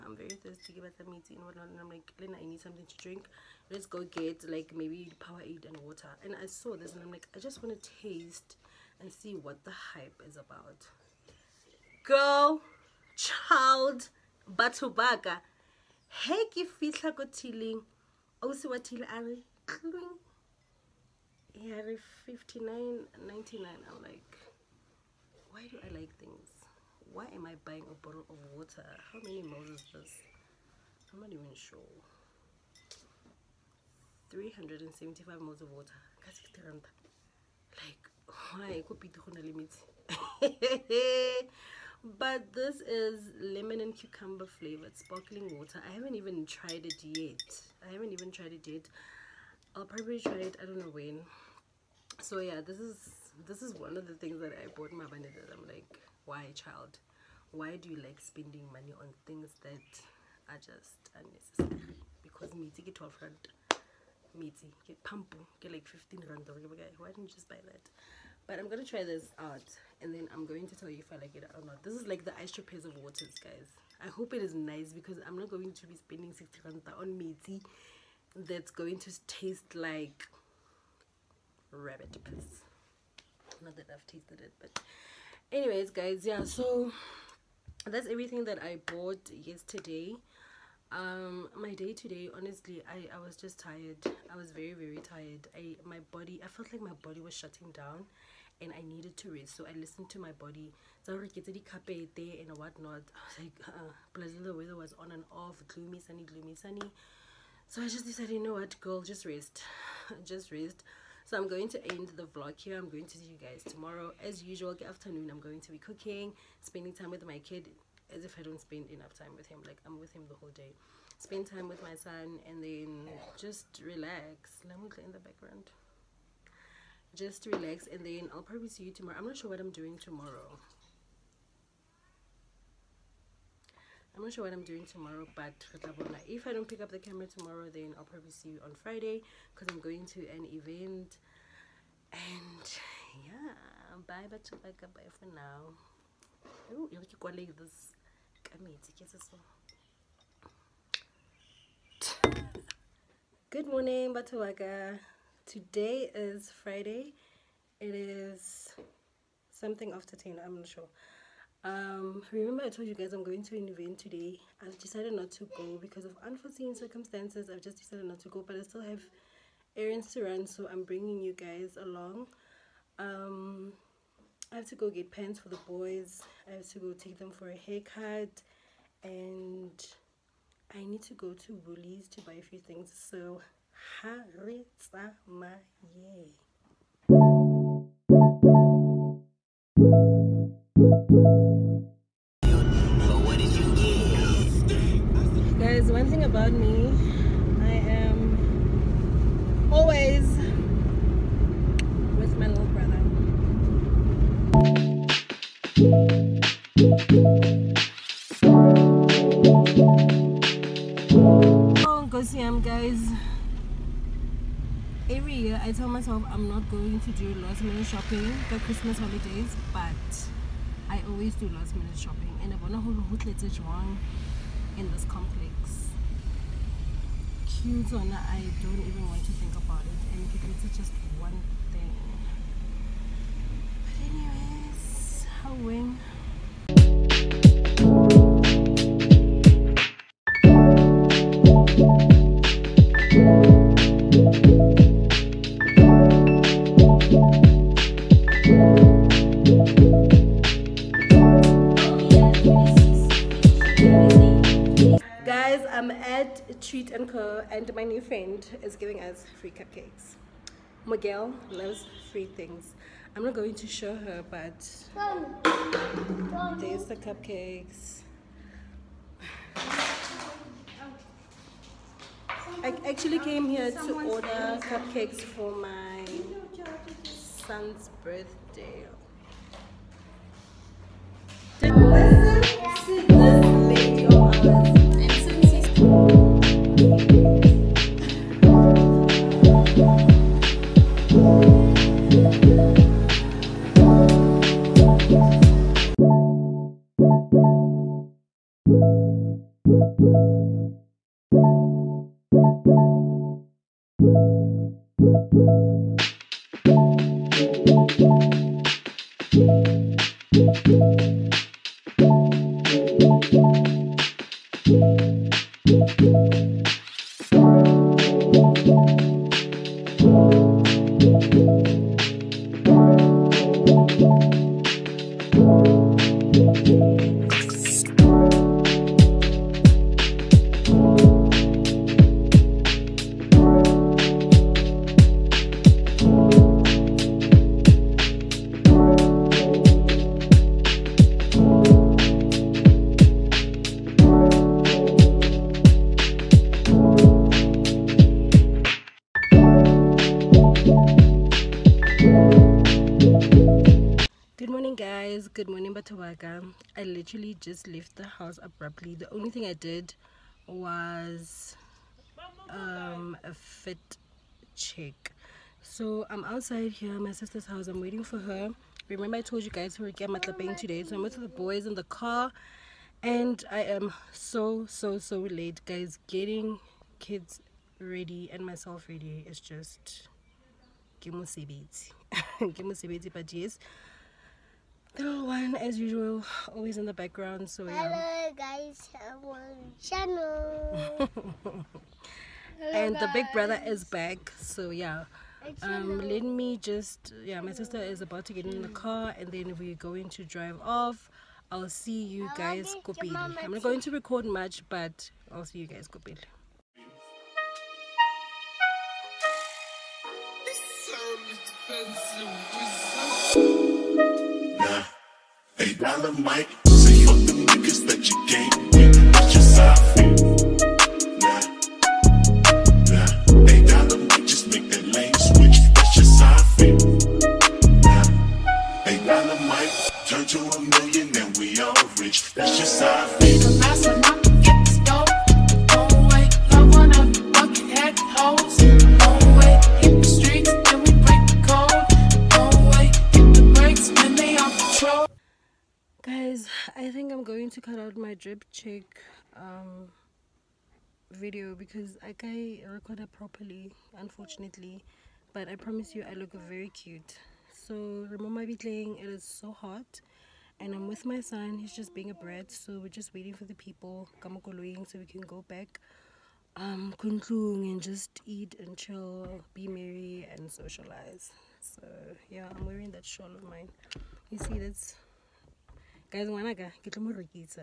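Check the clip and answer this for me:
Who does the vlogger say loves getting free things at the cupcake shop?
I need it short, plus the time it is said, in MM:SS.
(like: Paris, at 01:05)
Miguel, at 04:20.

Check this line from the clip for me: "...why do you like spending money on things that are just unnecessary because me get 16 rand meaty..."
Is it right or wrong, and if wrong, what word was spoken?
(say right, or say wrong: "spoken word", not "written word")
wrong: "12", not "16".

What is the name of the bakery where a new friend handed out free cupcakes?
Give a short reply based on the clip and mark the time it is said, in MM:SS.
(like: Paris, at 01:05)
Sweet and Co., at 04:16.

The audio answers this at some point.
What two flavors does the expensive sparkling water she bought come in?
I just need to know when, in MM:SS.
00:43.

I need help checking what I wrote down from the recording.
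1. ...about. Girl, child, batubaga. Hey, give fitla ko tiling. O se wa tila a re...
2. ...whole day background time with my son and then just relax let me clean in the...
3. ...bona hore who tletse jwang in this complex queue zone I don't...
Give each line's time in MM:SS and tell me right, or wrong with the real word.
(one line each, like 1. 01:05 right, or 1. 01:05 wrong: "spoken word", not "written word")
1. 00:10 right
2. 02:00 wrong: "spend", not "background"
3. 03:42 right.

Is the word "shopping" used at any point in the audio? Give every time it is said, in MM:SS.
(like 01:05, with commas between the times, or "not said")
03:37, 03:41.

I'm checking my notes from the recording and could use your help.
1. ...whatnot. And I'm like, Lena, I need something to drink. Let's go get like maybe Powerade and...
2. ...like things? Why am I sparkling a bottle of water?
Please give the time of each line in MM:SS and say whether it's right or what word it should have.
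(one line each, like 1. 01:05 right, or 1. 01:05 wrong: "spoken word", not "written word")
1. 00:01 right
2. 00:26 wrong: "buying", not "sparkling".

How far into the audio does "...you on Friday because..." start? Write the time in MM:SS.
02:18.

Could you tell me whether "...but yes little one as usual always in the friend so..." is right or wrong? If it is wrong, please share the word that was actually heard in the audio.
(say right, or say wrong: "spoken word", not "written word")
wrong: "background", not "friend".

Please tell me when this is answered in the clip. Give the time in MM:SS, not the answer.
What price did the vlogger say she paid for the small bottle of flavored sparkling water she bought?
00:22.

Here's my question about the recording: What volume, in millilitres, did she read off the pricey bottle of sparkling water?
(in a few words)
375.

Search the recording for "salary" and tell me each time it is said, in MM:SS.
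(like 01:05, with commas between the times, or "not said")
not said.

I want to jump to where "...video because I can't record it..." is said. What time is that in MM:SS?
07:31.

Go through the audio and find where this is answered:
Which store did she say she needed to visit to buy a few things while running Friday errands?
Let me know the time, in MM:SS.
03:01.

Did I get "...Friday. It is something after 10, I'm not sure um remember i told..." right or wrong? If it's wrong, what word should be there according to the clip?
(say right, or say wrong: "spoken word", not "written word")
right.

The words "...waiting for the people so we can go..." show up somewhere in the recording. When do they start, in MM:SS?
07:43.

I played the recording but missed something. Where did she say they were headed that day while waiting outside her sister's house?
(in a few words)
Matlapeng.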